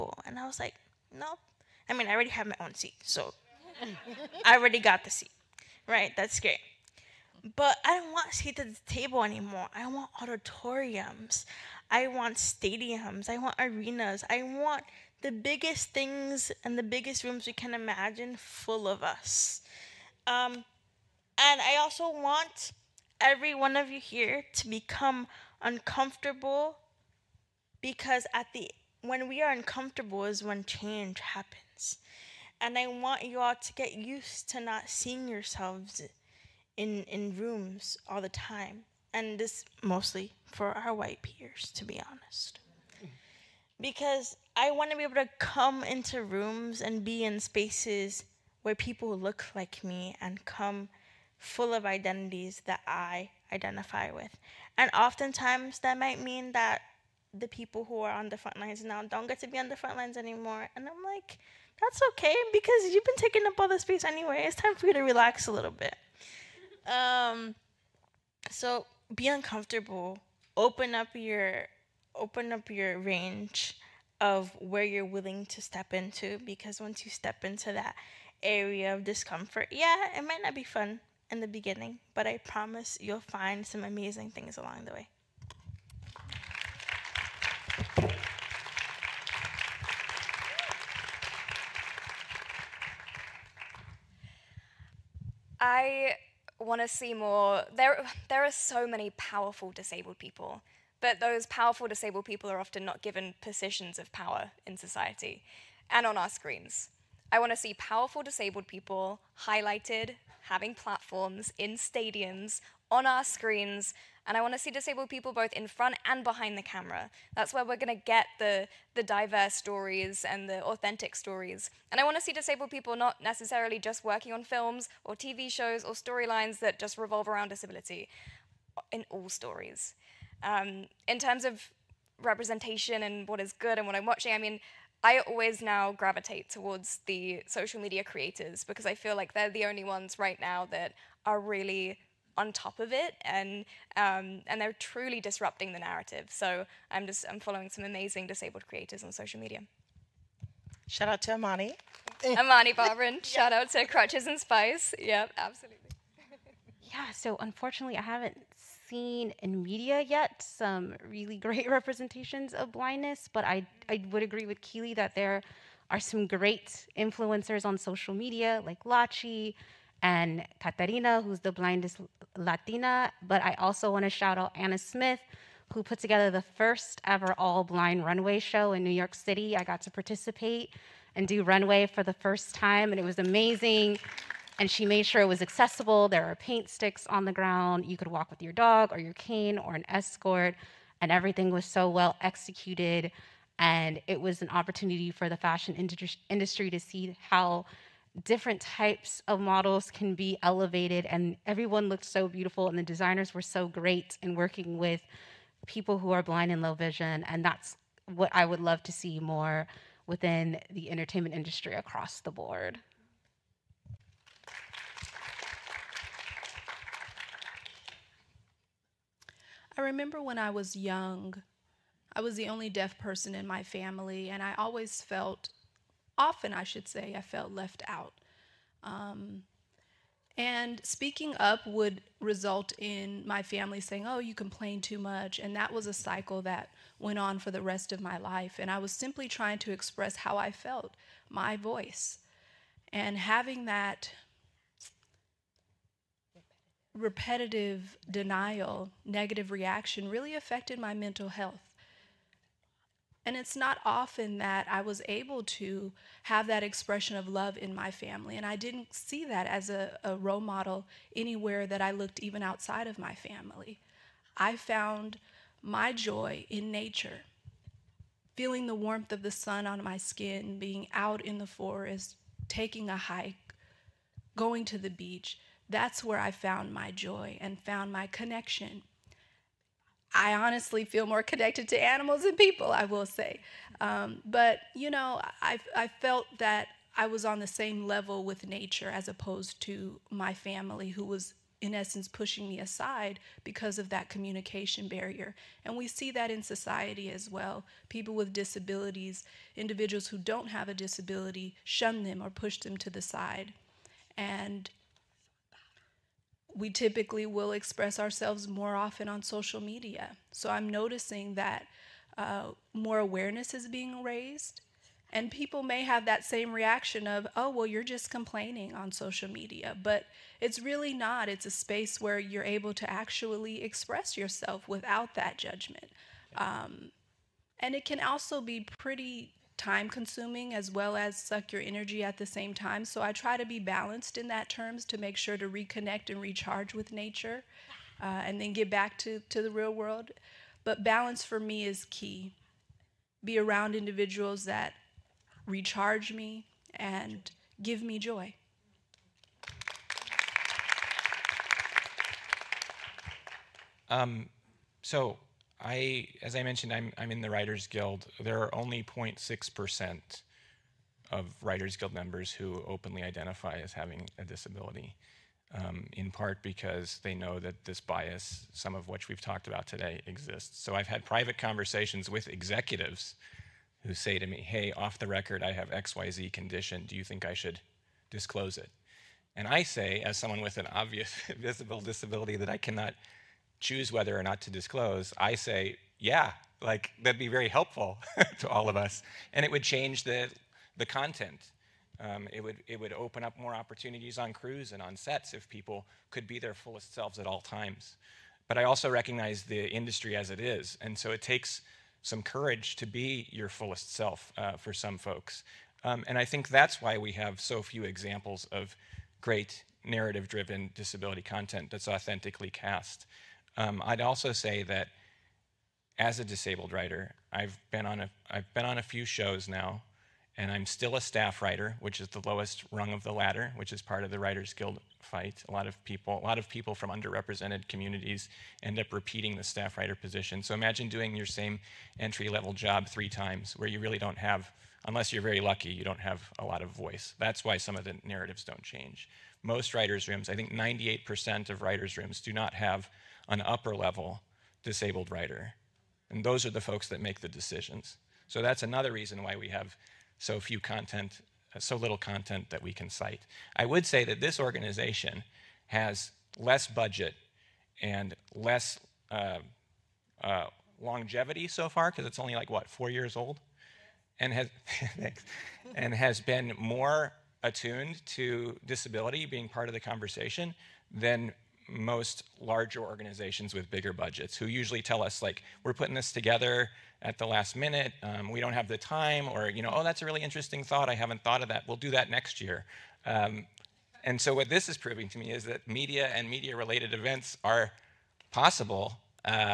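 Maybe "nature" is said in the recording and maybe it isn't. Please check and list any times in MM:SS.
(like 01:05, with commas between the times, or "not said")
04:26, 04:48, 05:36.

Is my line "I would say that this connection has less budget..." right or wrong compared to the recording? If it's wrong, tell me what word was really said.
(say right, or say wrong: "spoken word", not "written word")
wrong: "organization", not "connection".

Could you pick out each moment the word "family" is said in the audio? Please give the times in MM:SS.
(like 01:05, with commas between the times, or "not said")
03:43, 03:53, 04:17, 04:23, 04:50.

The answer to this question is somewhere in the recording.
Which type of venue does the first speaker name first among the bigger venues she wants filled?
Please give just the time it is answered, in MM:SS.
00:10.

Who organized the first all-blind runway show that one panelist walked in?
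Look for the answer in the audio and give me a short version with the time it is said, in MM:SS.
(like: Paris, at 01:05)
Anna Smith, at 02:54.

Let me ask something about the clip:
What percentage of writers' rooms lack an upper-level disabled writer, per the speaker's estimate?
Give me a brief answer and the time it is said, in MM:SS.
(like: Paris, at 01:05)
98%, at 07:20.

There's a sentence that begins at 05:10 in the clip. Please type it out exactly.
So I'm noticing that uh, more awareness is being raised.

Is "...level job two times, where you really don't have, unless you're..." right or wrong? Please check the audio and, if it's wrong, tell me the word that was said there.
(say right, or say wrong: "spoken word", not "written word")
wrong: "three", not "two".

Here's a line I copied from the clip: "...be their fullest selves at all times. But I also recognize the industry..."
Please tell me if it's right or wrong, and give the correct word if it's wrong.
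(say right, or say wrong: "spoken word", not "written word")
right.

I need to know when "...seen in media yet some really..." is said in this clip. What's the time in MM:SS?
02:38.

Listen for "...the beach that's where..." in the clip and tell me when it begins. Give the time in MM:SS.
04:34.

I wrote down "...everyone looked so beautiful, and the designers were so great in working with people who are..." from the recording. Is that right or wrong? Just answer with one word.
right.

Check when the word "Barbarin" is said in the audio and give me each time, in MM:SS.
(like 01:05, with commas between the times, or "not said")
02:32.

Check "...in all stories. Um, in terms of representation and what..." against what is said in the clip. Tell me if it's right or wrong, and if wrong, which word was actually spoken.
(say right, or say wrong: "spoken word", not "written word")
right.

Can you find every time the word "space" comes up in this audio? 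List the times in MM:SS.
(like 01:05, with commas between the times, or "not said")
00:47, 01:03, 05:21.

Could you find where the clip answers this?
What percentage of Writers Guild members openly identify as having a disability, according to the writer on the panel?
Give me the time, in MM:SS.
05:58.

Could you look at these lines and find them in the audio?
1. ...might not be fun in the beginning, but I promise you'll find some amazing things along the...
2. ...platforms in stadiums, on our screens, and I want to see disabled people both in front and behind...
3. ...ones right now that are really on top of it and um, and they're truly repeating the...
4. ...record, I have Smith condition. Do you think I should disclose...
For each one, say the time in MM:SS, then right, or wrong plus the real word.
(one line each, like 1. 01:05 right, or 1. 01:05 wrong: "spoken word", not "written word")
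1. 01:20 right
2. 01:50 right
3. 02:19 wrong: "disrupting", not "repeating"
4. 06:15 wrong: "XYZ", not "Smith".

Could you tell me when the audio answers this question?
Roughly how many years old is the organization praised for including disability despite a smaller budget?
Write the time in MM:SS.
07:42.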